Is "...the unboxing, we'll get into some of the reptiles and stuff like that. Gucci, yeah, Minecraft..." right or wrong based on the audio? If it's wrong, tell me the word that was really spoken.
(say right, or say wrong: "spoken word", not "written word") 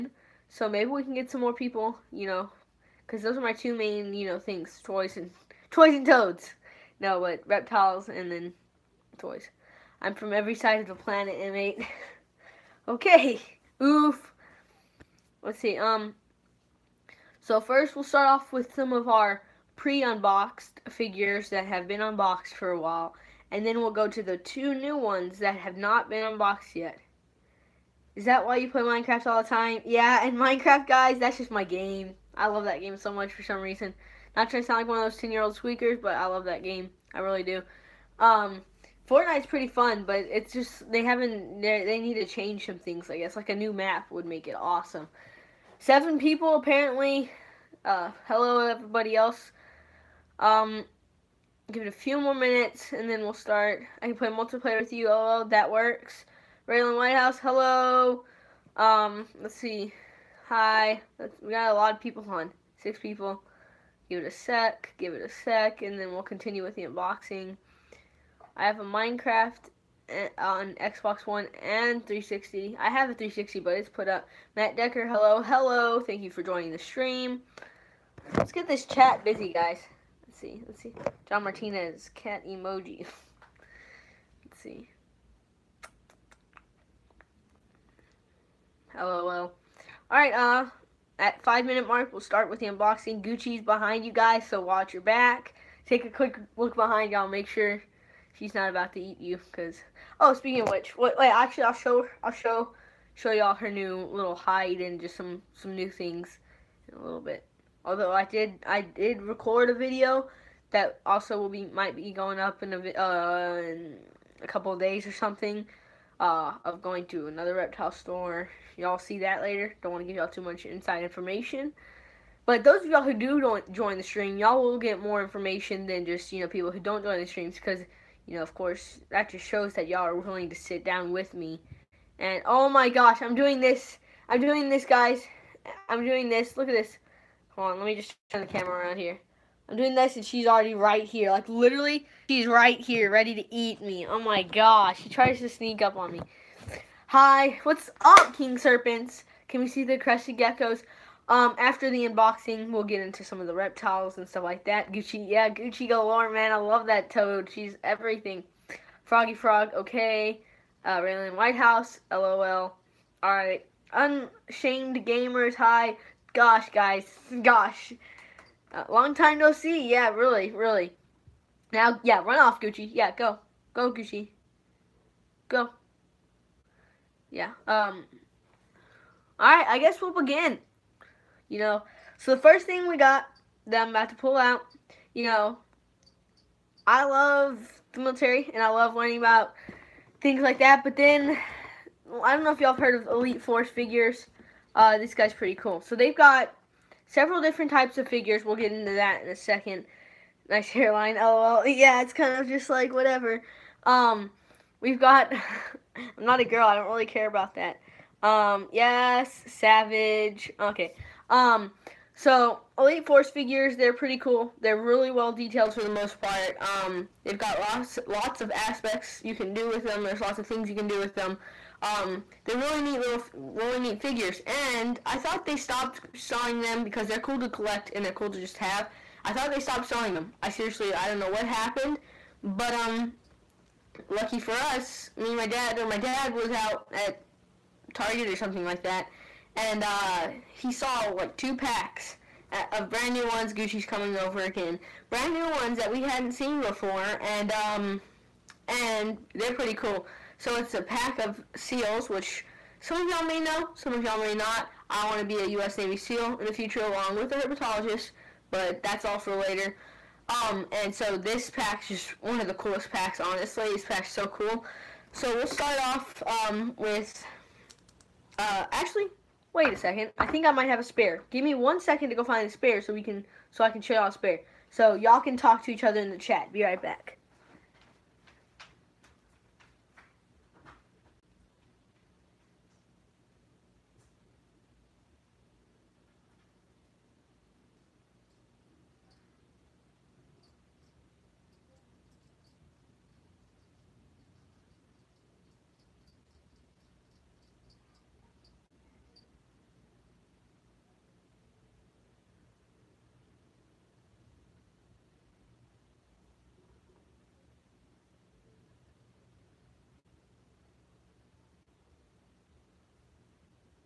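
wrong: "Gucci", not "Minecraft".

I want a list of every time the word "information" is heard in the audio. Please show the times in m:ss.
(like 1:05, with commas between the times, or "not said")
2:01, 2:05.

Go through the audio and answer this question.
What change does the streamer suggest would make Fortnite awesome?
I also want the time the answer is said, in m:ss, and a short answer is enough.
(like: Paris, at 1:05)
A new map, at 0:43.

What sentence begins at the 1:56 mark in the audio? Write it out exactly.
Uh, of going to another reptile store.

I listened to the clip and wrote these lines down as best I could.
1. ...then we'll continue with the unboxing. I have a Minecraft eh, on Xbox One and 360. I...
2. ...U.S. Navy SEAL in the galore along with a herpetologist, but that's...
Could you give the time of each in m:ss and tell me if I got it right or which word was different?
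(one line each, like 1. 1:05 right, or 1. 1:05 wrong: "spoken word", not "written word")
1. 1:05 right
2. 4:15 wrong: "future", not "galore".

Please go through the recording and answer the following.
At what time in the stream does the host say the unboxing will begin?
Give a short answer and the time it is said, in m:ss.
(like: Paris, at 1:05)
5 minute mark, at 1:31.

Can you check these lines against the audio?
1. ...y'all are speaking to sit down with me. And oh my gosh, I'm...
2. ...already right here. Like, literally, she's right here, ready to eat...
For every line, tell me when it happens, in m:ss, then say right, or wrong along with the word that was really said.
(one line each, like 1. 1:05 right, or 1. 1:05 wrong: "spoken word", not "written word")
1. 2:09 wrong: "willing", not "speaking"
2. 2:20 right.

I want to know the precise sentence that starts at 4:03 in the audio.
Gucci's coming over again, brand new ones that we hadn't seen before, and um, and they're pretty cool.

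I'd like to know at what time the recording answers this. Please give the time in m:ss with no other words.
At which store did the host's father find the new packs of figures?
3:57.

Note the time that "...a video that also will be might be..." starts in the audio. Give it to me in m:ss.
1:49.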